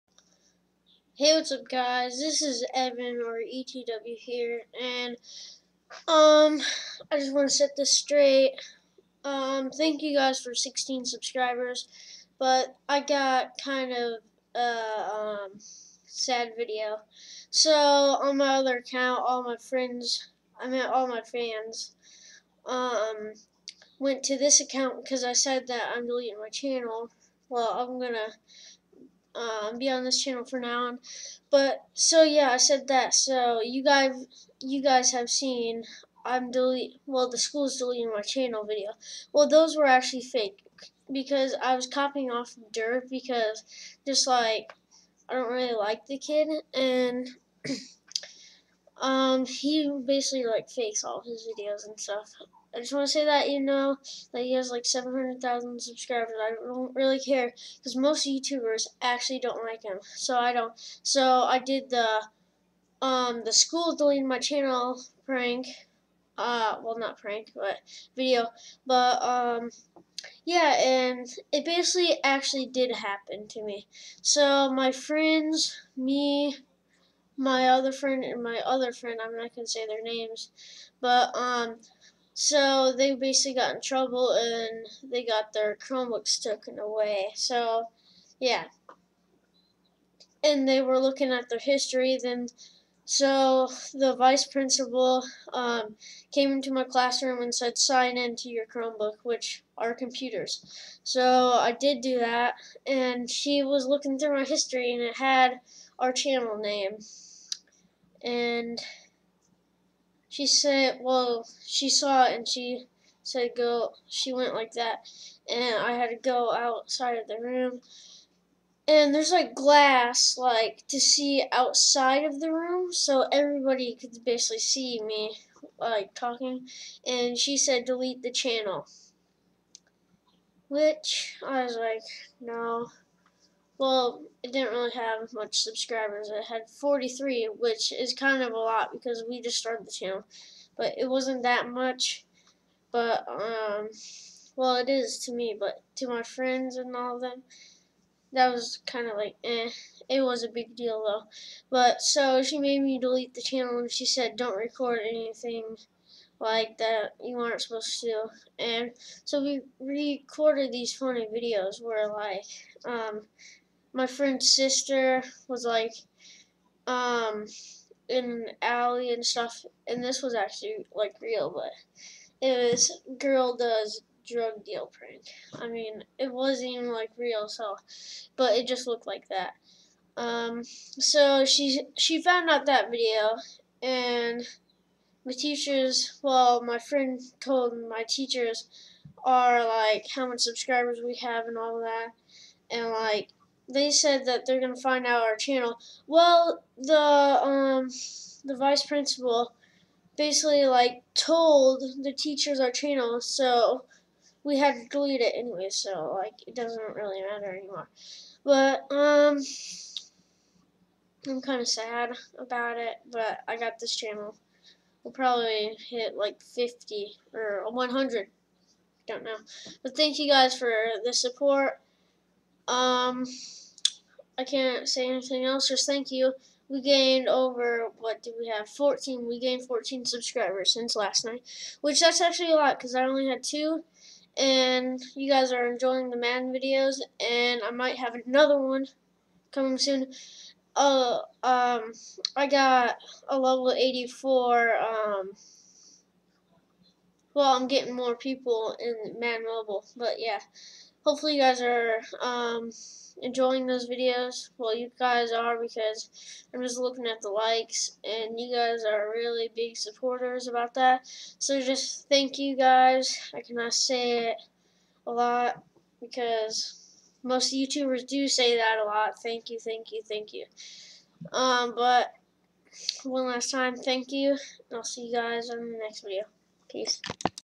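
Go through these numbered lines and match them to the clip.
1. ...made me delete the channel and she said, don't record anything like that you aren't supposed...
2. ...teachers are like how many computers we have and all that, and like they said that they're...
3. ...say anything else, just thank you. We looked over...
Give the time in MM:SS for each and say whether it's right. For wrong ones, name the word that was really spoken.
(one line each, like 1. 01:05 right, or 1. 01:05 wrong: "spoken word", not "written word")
1. 02:32 right
2. 03:08 wrong: "subscribers", not "computers"
3. 03:44 wrong: "gained", not "looked".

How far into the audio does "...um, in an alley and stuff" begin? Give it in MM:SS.
02:46.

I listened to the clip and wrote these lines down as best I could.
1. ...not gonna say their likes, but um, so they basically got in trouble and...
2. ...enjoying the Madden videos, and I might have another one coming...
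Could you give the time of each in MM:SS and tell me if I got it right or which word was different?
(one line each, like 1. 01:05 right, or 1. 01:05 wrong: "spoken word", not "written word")
1. 01:19 wrong: "names", not "likes"
2. 03:55 right.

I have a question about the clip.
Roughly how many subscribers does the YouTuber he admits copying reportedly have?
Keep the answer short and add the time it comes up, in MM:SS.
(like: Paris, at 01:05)
700,000, at 00:54.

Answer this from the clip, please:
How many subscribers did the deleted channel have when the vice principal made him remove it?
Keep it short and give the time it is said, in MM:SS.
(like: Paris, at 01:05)
43, at 02:16.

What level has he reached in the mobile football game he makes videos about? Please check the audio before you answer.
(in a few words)
84.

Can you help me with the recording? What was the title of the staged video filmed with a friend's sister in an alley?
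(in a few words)
Girl does drug deal prank.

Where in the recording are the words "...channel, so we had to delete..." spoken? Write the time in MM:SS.
03:22.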